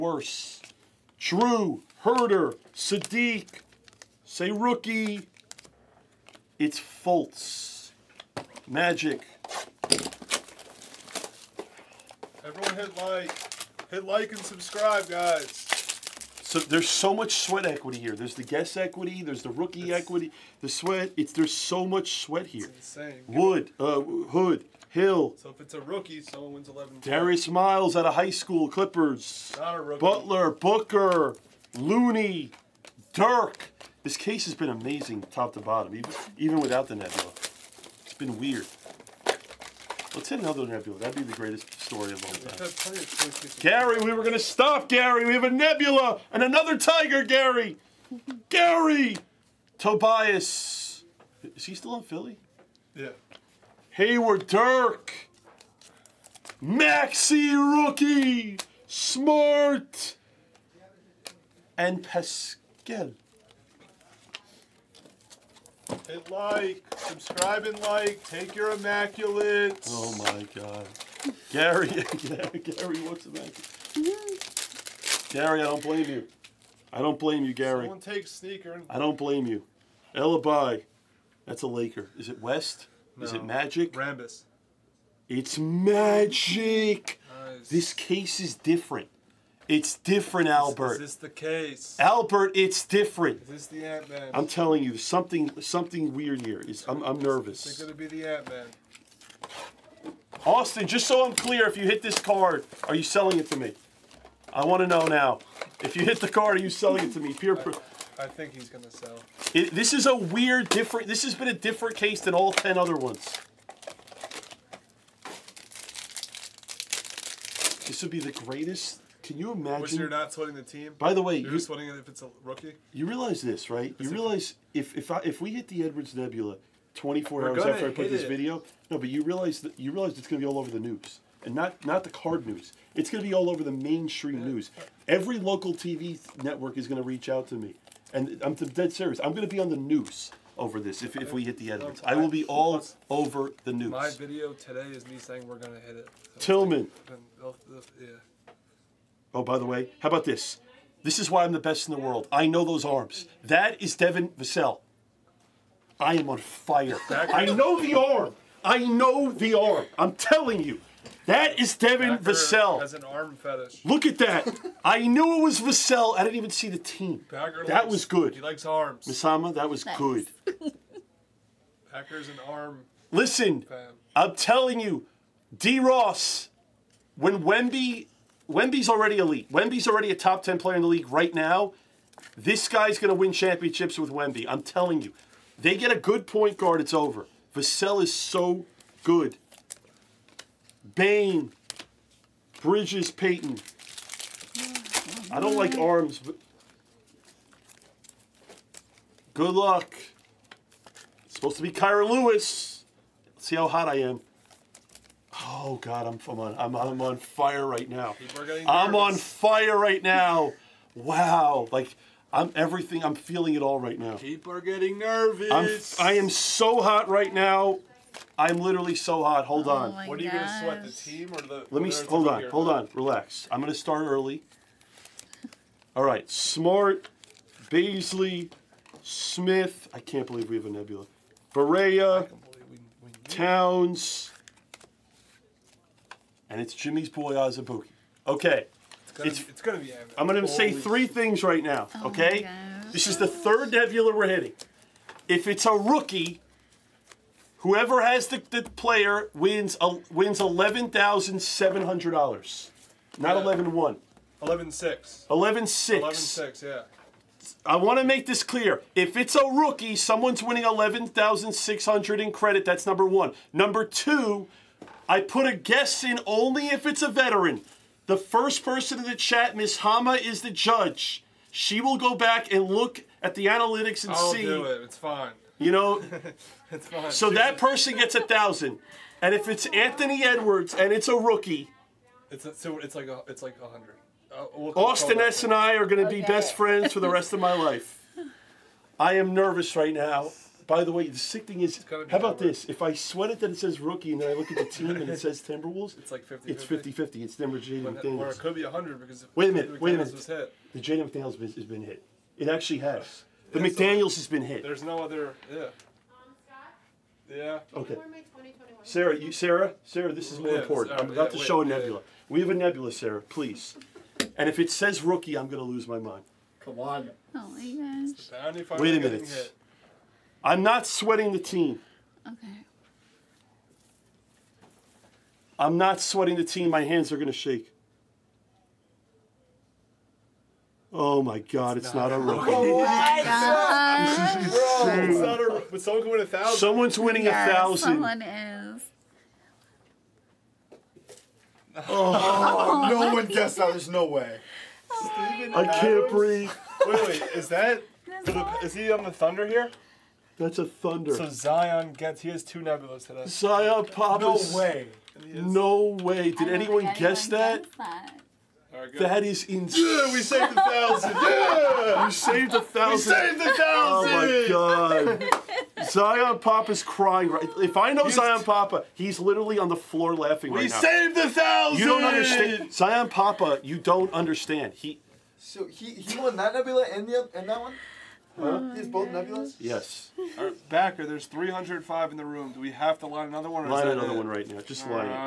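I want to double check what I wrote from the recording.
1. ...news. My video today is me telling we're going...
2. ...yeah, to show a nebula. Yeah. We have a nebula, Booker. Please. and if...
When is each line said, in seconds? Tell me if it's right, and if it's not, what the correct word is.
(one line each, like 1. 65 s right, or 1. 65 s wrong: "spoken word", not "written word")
1. 143 s wrong: "saying", not "telling"
2. 311 s wrong: "Sarah", not "Booker".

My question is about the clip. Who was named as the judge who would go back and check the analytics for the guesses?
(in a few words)
Miss Hama.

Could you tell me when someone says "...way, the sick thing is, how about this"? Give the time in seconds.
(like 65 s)
290 s.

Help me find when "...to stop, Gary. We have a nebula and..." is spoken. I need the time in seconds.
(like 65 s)
44 s.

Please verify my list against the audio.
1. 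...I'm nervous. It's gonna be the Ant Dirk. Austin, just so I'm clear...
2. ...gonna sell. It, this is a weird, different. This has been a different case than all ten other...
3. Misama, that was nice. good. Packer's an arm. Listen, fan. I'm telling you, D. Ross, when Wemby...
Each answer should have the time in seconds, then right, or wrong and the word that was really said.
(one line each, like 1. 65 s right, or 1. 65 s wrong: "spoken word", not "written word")
1. 97 s wrong: "Man", not "Dirk"
2. 108 s right
3. 169 s right.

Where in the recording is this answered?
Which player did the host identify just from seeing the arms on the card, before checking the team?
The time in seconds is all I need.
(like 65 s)
153 s.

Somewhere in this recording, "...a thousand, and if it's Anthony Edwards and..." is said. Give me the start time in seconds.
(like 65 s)
278 s.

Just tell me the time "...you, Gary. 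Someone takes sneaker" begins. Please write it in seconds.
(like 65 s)
77 s.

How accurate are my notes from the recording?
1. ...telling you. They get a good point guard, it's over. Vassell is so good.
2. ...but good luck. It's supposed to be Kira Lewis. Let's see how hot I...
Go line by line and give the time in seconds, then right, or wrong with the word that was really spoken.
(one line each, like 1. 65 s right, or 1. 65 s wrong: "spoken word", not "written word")
1. 184 s right
2. 196 s right.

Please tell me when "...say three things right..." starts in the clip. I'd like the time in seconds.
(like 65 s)
240 s.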